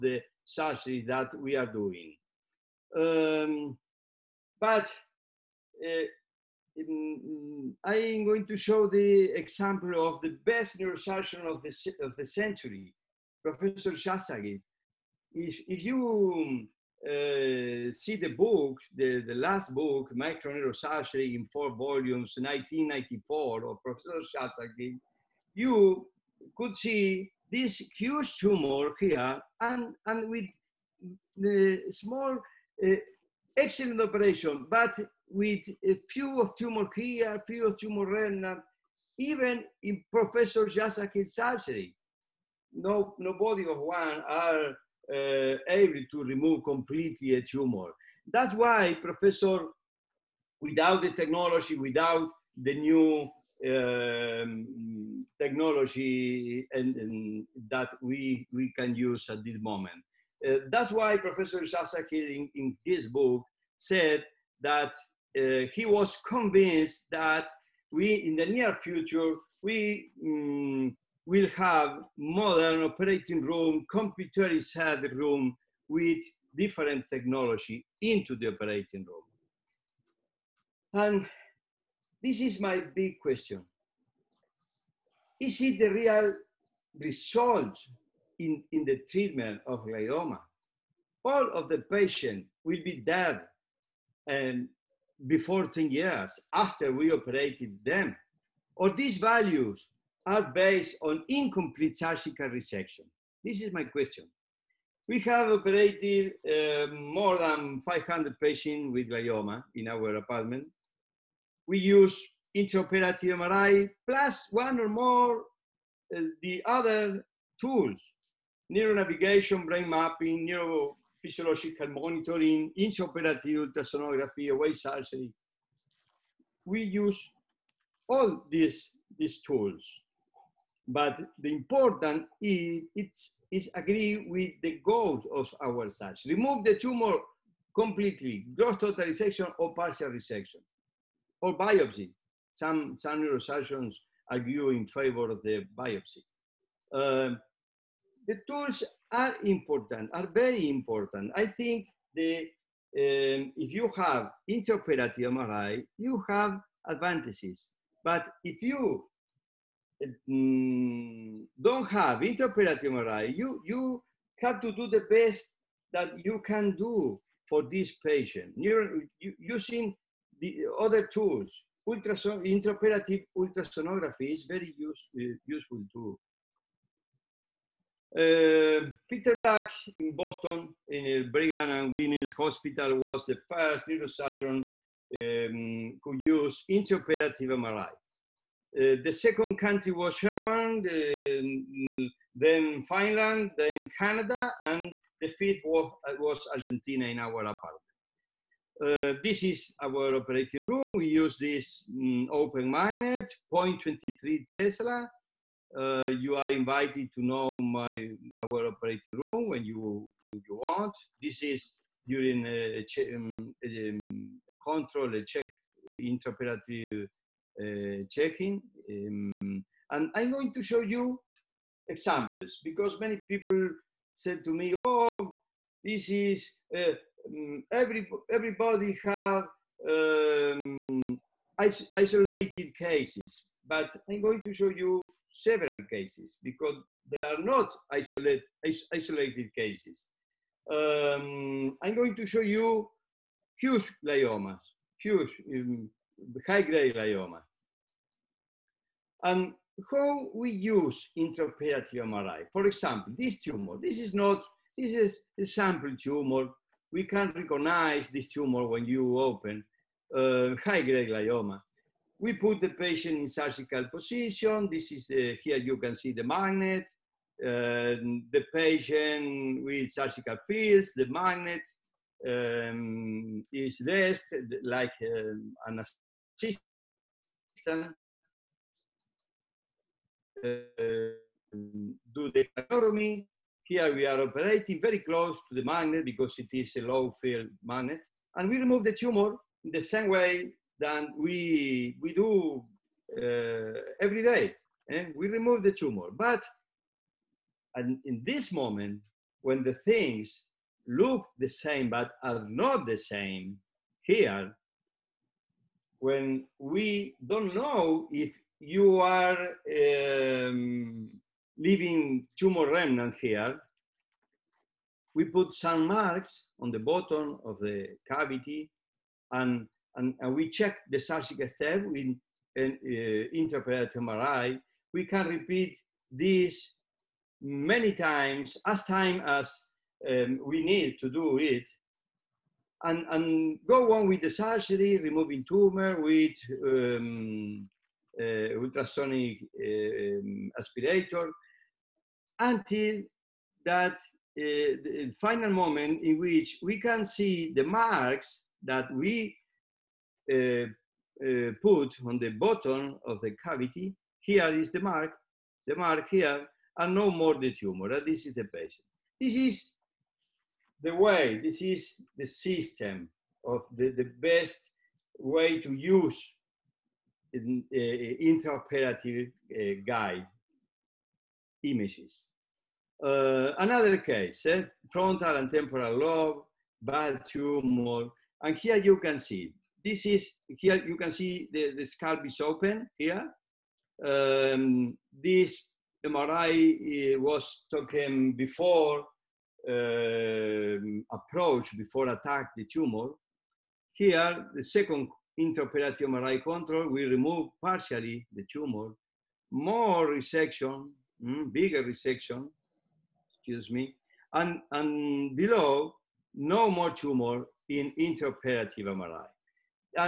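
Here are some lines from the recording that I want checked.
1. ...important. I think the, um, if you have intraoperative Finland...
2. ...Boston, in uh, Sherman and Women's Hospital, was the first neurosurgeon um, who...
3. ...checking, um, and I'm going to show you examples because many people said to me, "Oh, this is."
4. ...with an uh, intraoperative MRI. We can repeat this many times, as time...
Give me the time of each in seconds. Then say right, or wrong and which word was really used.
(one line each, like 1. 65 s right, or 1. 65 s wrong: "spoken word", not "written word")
1. 150 s wrong: "MRI", not "Finland"
2. 180 s wrong: "Brigham", not "Sherman"
3. 218 s right
4. 321 s right.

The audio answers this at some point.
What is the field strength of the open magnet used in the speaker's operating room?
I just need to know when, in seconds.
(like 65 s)
203 s.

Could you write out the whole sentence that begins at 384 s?
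Um, this MRI eh, was taken before um, approach, before attack the tumor.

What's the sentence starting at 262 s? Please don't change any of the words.
We put the patient in surgical position.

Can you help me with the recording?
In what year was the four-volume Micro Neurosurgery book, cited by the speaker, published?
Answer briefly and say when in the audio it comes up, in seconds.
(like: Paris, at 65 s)
1994, at 22 s.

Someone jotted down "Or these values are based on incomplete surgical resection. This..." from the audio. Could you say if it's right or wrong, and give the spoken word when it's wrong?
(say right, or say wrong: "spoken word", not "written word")
right.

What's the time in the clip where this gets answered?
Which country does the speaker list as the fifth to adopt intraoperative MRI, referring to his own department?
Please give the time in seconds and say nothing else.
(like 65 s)
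196 s.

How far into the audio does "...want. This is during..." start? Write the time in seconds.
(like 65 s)
210 s.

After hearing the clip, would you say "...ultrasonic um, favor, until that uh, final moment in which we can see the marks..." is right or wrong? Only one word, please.
wrong.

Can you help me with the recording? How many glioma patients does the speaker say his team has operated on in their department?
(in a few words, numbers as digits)
more than 500.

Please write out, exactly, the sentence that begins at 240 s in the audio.
Um, I'm going to show you huge gliomas, huge um, high-grade glioma.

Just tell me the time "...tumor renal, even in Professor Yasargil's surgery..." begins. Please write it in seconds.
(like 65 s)
37 s.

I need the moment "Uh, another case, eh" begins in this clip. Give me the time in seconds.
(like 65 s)
373 s.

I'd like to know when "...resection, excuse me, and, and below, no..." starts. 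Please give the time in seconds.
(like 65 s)
401 s.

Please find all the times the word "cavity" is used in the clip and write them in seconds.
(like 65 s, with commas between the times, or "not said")
318 s, 353 s.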